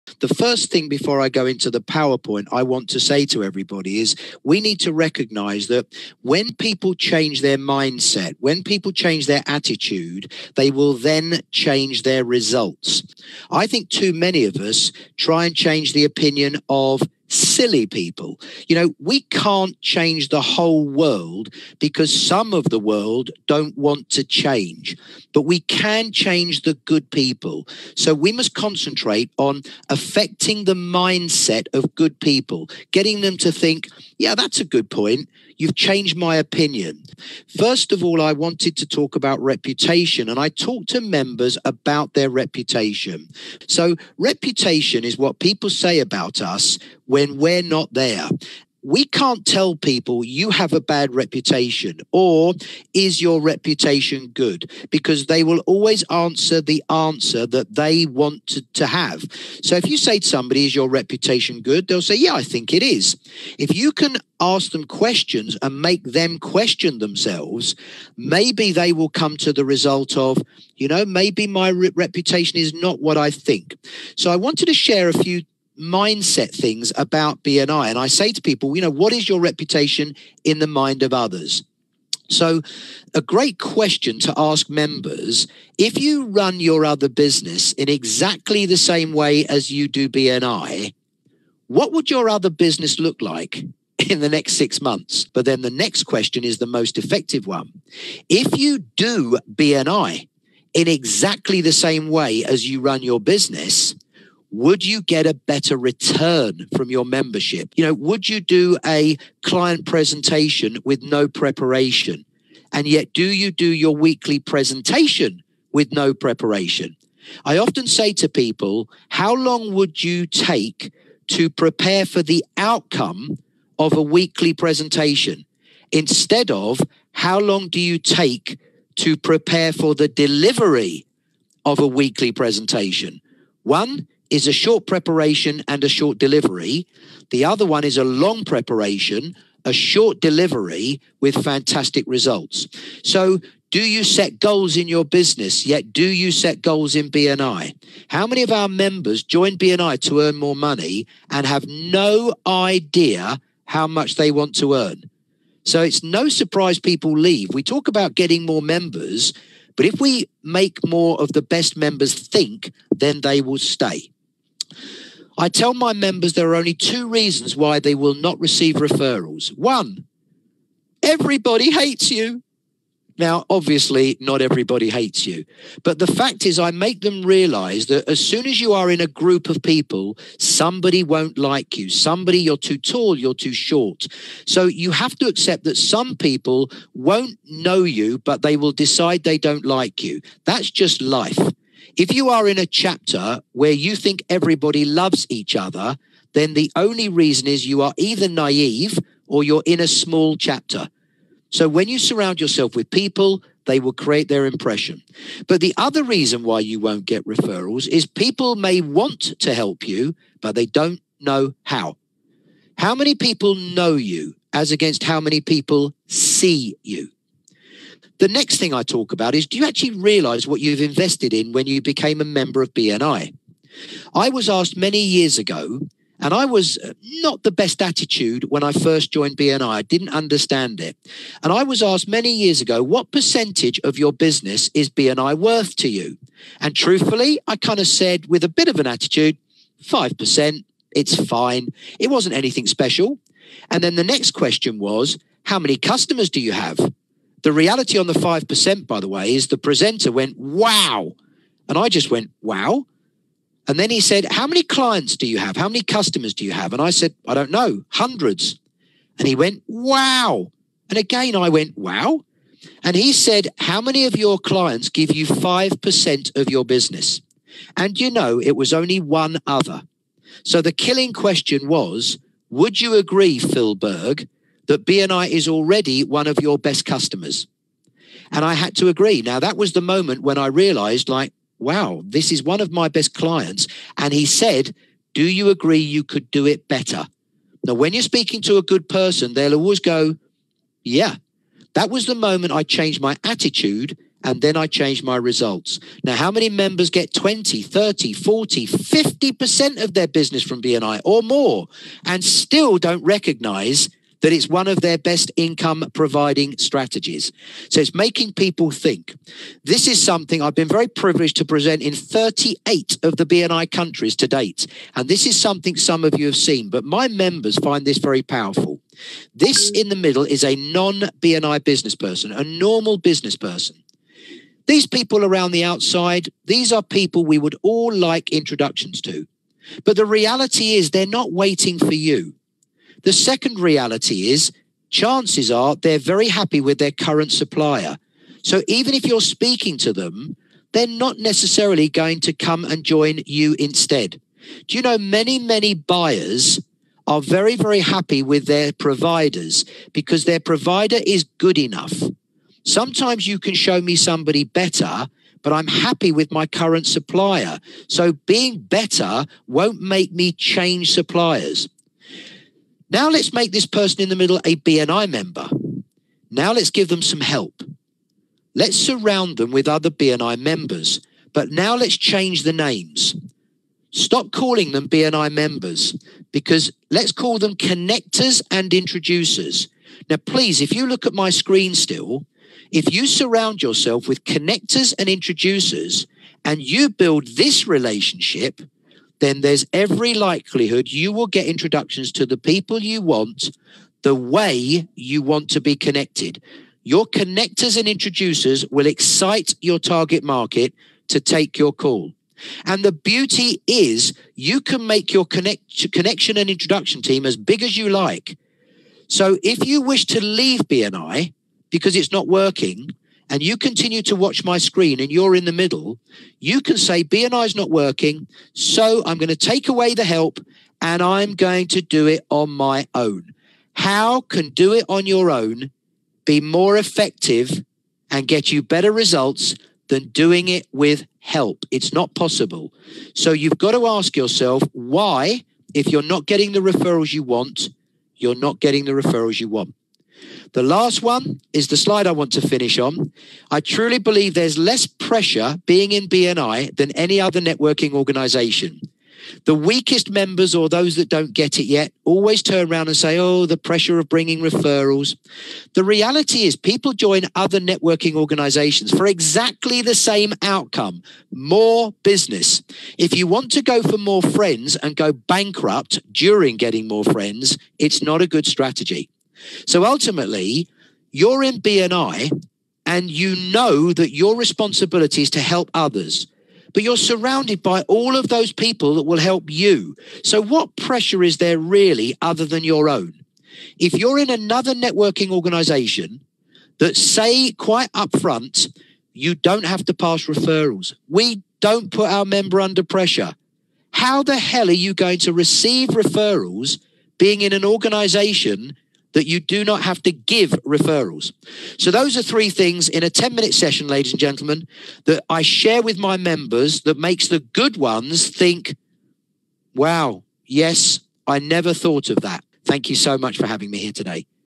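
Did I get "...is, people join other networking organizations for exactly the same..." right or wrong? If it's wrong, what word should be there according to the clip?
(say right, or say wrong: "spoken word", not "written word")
right.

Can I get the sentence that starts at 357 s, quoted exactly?
So being better won't make me change suppliers.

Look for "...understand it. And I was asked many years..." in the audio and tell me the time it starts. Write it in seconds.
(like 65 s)
230 s.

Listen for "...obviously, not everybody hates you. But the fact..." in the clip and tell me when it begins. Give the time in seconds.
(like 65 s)
173 s.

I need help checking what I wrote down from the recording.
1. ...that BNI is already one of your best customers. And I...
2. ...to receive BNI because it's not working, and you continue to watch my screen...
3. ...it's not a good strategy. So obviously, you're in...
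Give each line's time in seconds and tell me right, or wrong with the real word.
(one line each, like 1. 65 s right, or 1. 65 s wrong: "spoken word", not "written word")
1. 274 s right
2. 410 s wrong: "leave", not "receive"
3. 467 s wrong: "ultimately", not "obviously".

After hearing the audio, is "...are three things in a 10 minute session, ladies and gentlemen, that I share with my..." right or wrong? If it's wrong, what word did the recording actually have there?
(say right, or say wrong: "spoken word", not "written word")
right.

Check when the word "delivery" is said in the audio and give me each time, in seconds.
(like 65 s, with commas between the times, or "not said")
130 s, 136 s, 140 s.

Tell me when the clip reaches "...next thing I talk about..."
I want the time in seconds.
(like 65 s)
218 s.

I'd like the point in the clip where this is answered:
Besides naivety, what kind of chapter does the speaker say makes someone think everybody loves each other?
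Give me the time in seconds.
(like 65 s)
199 s.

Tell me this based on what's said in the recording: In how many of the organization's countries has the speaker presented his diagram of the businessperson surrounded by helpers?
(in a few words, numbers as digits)
38.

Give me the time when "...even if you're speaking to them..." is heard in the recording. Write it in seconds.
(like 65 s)
338 s.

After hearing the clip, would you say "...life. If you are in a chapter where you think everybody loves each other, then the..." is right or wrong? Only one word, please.
right.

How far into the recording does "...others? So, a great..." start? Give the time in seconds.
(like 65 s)
81 s.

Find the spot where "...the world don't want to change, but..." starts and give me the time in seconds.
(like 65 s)
22 s.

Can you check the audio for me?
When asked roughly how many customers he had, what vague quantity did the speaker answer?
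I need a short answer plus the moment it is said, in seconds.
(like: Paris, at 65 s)
hundreds, at 257 s.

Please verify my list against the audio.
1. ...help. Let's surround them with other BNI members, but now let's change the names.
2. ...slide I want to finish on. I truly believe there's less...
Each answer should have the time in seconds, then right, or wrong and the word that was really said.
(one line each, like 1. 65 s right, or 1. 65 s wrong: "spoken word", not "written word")
1. 367 s right
2. 441 s right.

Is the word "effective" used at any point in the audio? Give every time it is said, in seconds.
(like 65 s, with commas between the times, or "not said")
96 s, 426 s.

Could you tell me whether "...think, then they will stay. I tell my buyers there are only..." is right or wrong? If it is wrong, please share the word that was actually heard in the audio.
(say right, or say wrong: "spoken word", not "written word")
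wrong: "members", not "buyers".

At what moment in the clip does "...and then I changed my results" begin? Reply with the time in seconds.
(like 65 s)
294 s.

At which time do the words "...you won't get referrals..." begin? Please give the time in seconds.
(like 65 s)
206 s.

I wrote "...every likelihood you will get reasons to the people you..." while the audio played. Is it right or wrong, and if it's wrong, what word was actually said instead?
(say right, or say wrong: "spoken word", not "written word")
wrong: "introductions", not "reasons".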